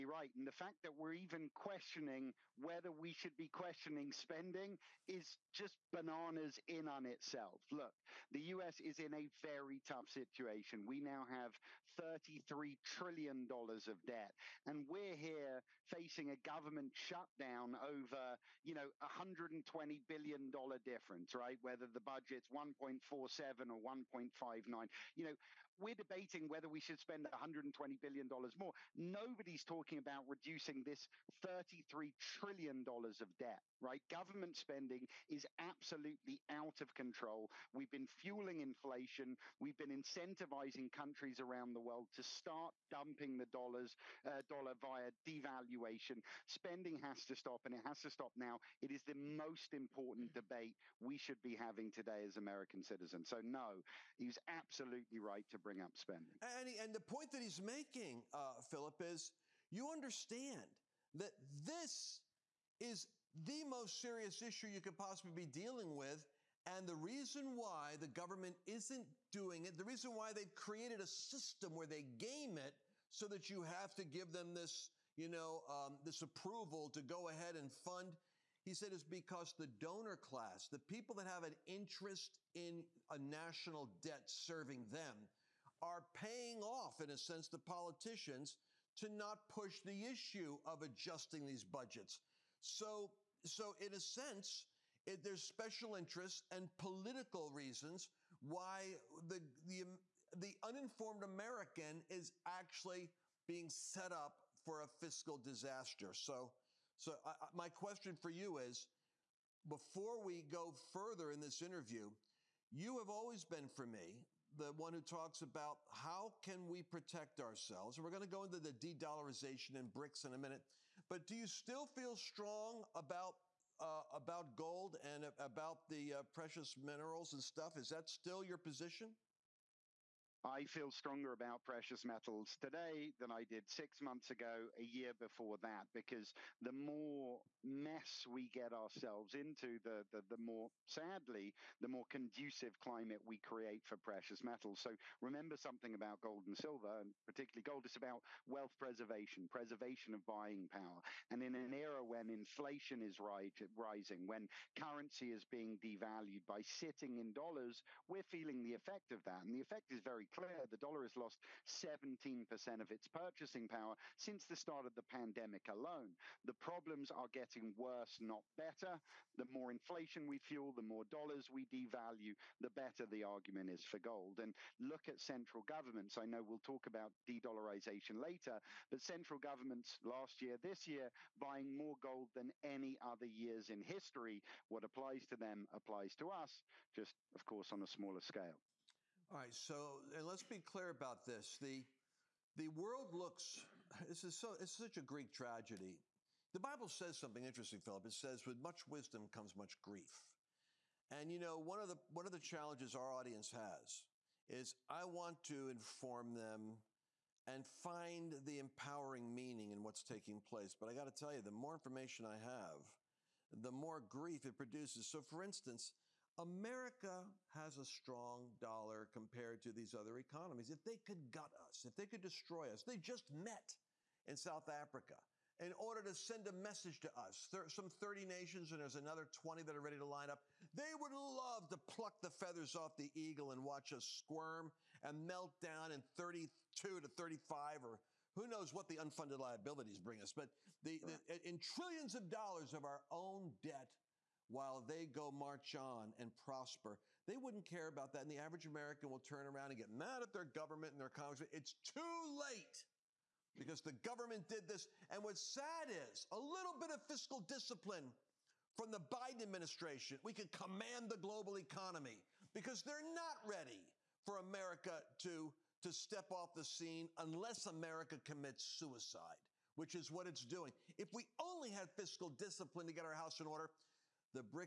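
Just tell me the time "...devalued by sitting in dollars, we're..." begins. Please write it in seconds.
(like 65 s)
155 s.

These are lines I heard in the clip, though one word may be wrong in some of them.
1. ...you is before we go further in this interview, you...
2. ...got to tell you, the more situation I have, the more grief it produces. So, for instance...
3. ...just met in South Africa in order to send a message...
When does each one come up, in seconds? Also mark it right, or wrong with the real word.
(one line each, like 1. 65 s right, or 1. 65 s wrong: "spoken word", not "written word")
1. 108 s right
2. 210 s wrong: "information", not "situation"
3. 222 s right.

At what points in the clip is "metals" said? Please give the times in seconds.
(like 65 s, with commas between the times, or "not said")
132 s, 144 s.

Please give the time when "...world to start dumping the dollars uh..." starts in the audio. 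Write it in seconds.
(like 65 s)
41 s.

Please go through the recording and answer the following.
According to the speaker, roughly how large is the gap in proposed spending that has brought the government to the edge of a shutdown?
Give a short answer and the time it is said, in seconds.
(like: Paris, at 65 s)
$120 billion, at 18 s.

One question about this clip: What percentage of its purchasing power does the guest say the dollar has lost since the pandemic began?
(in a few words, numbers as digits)
17%.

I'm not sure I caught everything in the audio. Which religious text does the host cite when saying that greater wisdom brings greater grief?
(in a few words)
The Bible.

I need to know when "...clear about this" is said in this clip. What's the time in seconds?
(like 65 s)
190 s.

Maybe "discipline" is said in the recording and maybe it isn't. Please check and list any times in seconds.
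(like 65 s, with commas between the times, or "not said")
257 s, 272 s.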